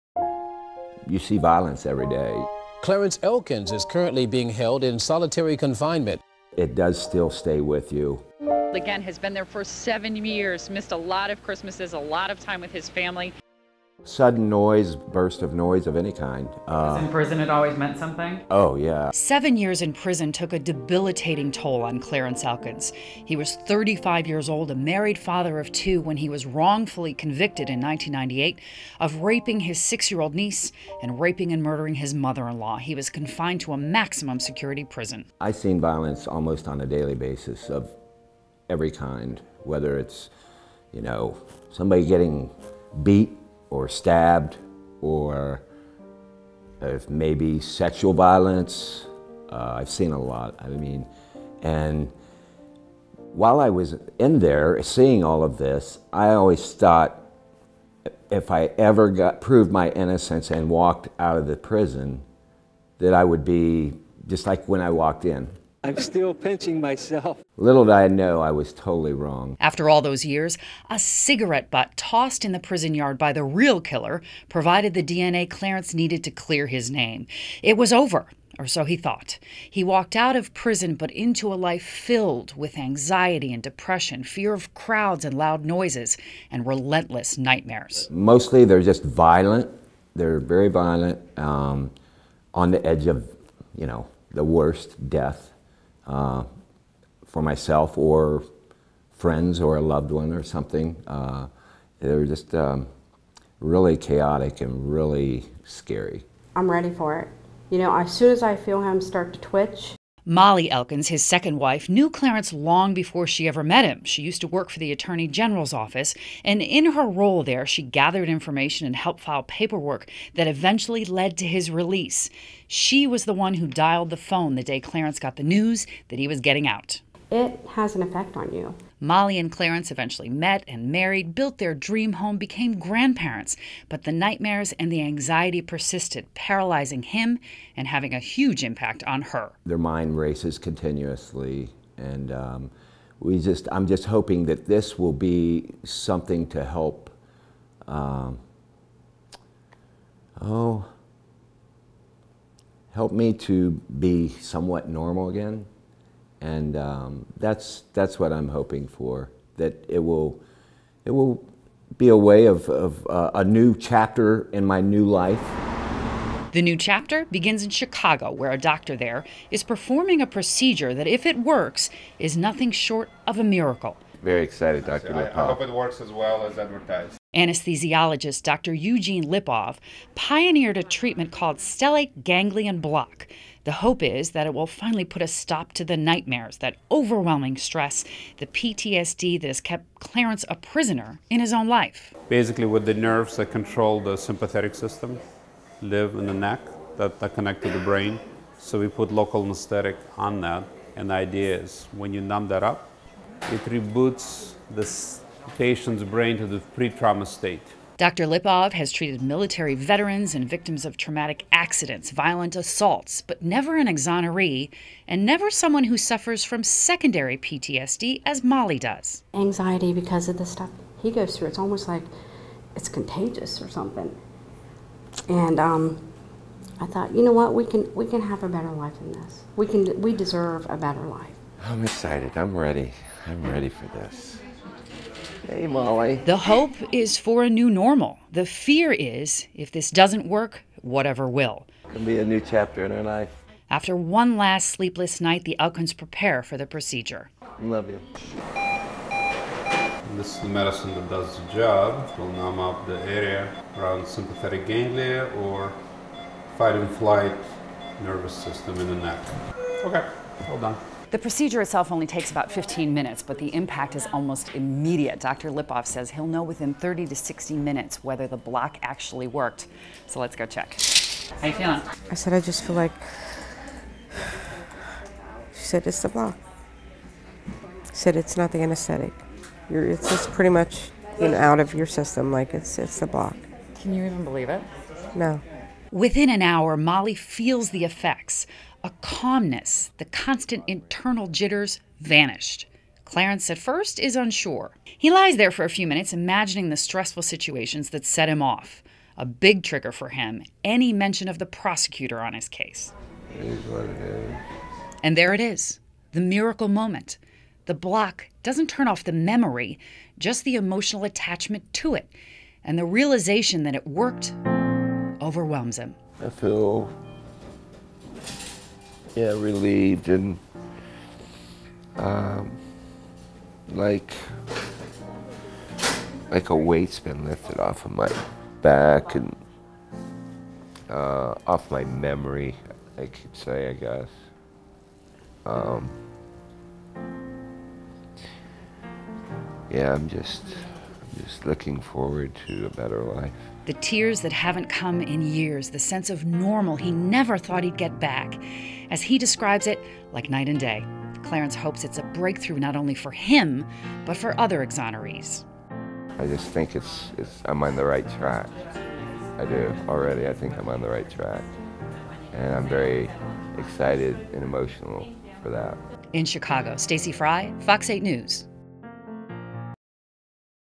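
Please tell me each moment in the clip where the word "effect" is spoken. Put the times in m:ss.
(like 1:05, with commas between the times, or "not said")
2:08, 4:47.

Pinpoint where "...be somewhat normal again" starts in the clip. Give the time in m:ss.
2:33.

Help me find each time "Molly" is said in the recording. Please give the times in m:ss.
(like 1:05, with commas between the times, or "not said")
1:50, 2:09, 3:38, 3:55, 4:46.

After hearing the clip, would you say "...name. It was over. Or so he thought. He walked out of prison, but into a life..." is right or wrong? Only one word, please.
right.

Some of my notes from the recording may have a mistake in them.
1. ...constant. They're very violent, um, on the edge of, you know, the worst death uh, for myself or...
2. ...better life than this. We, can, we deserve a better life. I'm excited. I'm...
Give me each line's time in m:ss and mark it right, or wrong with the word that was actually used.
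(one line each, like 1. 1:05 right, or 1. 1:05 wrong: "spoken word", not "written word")
1. 1:29 wrong: "violent", not "constant"
2. 3:48 right.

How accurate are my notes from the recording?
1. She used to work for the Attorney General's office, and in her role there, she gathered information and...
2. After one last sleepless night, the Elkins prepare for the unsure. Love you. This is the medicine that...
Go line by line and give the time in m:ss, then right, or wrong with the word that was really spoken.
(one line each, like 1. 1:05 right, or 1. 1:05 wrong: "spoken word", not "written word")
1. 1:54 right
2. 4:03 wrong: "procedure", not "unsure".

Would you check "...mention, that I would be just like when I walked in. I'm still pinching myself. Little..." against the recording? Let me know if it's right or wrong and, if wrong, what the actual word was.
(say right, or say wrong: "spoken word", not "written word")
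wrong: "prison", not "mention".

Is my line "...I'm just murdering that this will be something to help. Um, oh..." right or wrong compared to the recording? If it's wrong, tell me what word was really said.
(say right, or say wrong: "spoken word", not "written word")
wrong: "hoping", not "murdering".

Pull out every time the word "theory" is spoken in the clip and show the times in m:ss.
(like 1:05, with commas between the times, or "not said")
not said.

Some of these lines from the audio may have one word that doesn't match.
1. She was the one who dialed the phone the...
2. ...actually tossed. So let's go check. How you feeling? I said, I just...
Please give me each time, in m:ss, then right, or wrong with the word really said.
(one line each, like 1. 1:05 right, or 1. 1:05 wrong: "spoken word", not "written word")
1. 2:02 right
2. 4:28 wrong: "worked", not "tossed".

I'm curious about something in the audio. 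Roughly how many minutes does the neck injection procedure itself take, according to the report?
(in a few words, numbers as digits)
15.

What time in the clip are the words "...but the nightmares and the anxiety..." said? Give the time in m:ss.
2:13.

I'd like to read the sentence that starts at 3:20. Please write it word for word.
And the idea is when you numb that up, it reboots the patient's brain to the pre trauma state.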